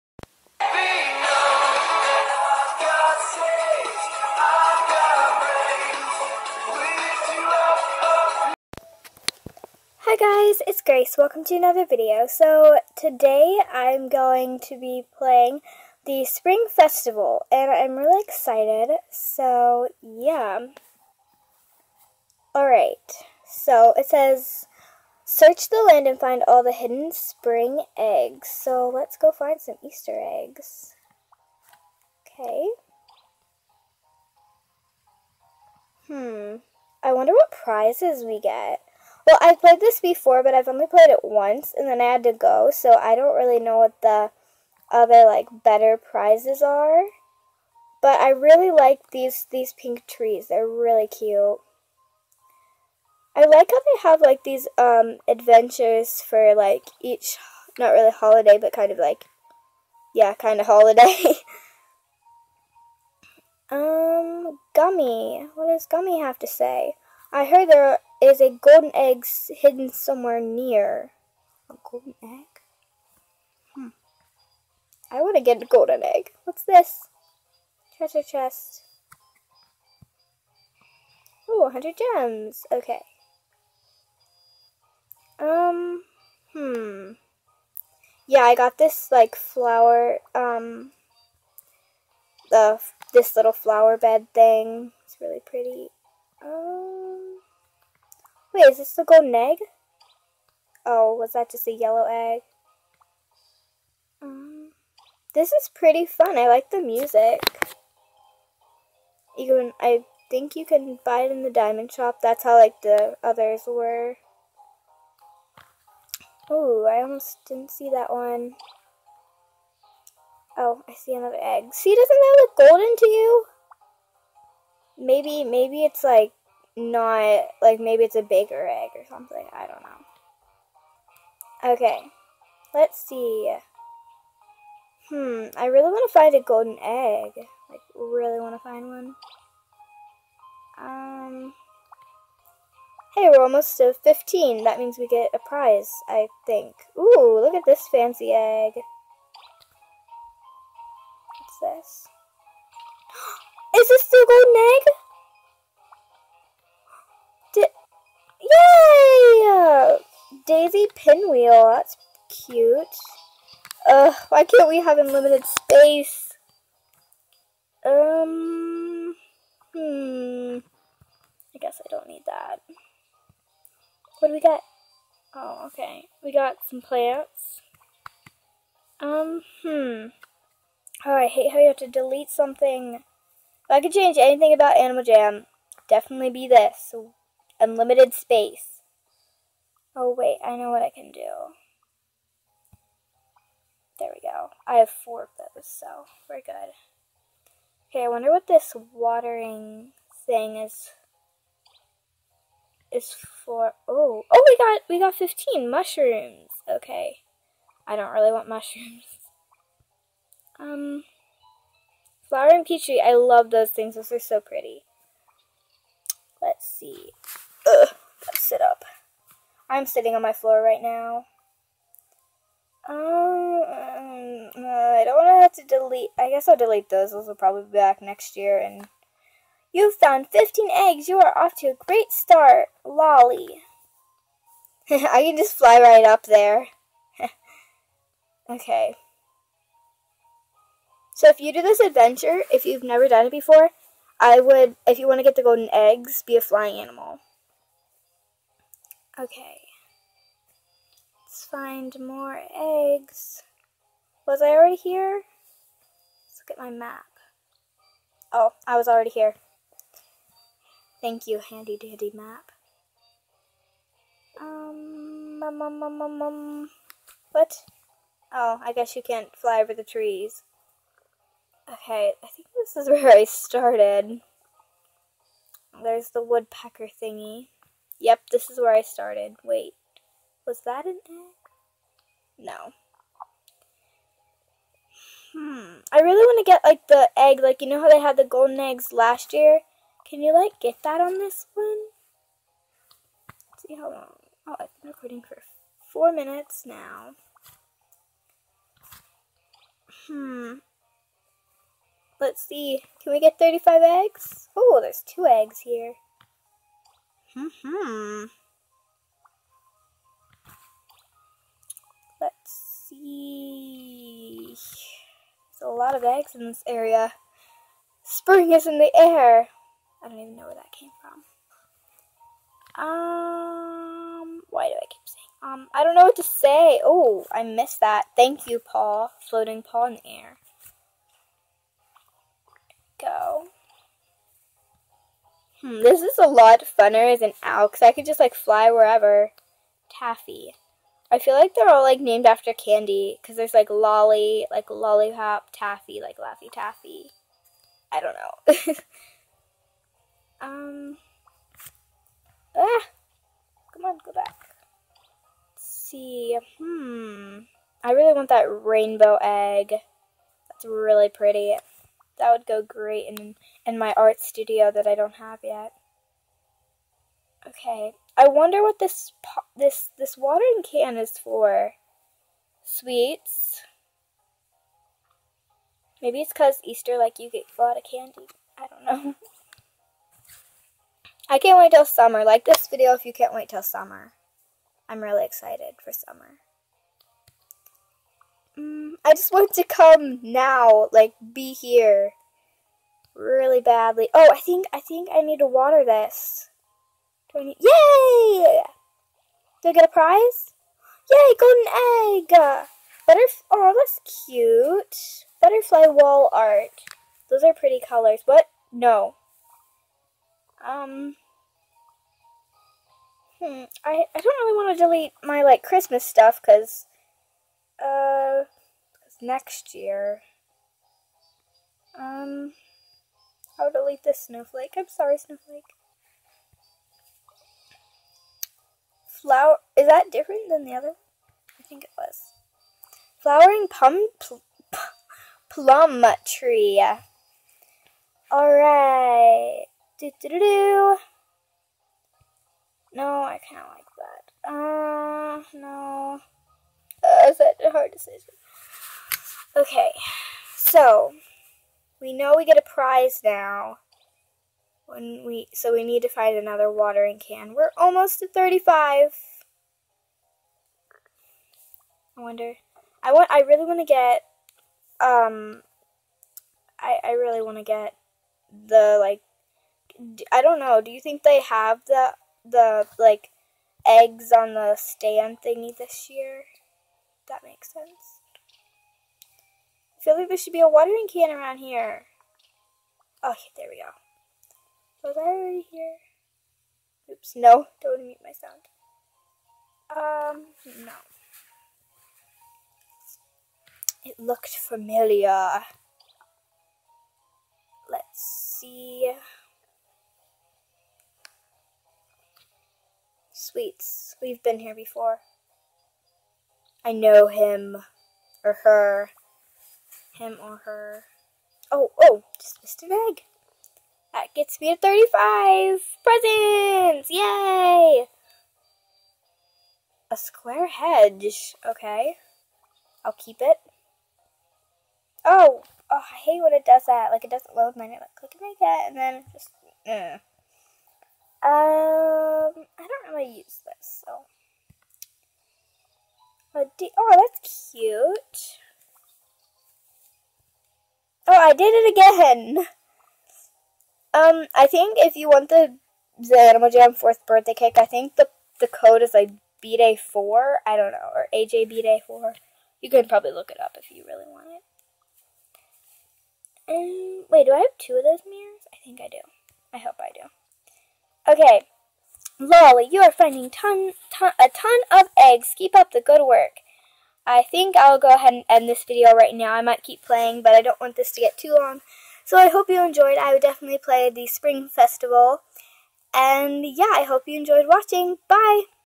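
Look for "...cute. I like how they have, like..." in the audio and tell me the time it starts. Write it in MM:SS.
00:51.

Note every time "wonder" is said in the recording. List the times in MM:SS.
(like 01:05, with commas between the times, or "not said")
00:37, 03:18, 06:08, 07:42.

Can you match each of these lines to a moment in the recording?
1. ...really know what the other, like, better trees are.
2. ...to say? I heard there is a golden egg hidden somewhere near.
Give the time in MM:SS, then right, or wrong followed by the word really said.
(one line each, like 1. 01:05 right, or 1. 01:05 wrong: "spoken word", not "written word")
1. 00:43 wrong: "prizes", not "trees"
2. 01:06 right.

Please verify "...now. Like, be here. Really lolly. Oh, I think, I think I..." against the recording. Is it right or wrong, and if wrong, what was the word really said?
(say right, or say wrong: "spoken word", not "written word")
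wrong: "badly", not "lolly".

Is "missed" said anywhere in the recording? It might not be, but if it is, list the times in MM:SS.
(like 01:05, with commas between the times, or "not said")
05:27, 08:32.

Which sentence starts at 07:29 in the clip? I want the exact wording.
Okay, so we know we get a prize now when we so we need to find another watering can.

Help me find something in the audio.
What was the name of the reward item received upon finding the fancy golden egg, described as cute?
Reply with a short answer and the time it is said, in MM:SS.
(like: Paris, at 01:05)
Daisy Pinwheel, at 02:40.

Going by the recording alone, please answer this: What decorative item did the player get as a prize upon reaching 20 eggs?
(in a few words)
Butterfly wall art.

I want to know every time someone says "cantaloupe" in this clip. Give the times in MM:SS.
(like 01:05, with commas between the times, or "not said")
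not said.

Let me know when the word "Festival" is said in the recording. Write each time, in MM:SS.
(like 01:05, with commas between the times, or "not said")
00:16, 09:34.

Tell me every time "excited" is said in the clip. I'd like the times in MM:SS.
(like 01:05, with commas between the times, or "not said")
00:18, 06:25.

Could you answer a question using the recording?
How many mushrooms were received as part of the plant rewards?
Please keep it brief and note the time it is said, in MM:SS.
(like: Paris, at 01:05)
15, at 03:25.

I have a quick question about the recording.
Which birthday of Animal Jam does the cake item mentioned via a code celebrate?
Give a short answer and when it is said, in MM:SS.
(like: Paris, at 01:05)
fourth, at 09:06.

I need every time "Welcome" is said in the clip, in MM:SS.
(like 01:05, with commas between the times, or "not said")
00:11.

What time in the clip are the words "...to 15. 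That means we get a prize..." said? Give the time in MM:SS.
02:23.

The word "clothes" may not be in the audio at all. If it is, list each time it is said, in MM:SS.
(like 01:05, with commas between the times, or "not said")
not said.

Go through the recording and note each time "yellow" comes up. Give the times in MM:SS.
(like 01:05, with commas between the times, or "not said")
01:41.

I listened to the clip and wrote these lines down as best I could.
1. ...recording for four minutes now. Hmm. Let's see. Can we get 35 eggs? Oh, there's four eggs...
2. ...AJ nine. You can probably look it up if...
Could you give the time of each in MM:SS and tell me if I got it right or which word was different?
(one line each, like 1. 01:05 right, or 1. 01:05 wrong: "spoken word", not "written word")
1. 04:54 wrong: "two", not "four"
2. 09:11 wrong: "four", not "nine".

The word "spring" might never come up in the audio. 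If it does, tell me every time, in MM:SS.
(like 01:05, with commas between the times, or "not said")
00:16, 00:27, 05:18, 09:34.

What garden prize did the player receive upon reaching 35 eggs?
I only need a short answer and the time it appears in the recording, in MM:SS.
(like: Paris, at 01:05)
square hedge, at 08:40.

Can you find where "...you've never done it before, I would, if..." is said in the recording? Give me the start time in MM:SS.
04:02.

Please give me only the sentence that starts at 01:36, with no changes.
Um, Wait, is this the golden egg?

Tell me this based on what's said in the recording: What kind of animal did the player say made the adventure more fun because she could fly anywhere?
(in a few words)
owl.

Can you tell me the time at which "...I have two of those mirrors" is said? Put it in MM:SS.
09:17.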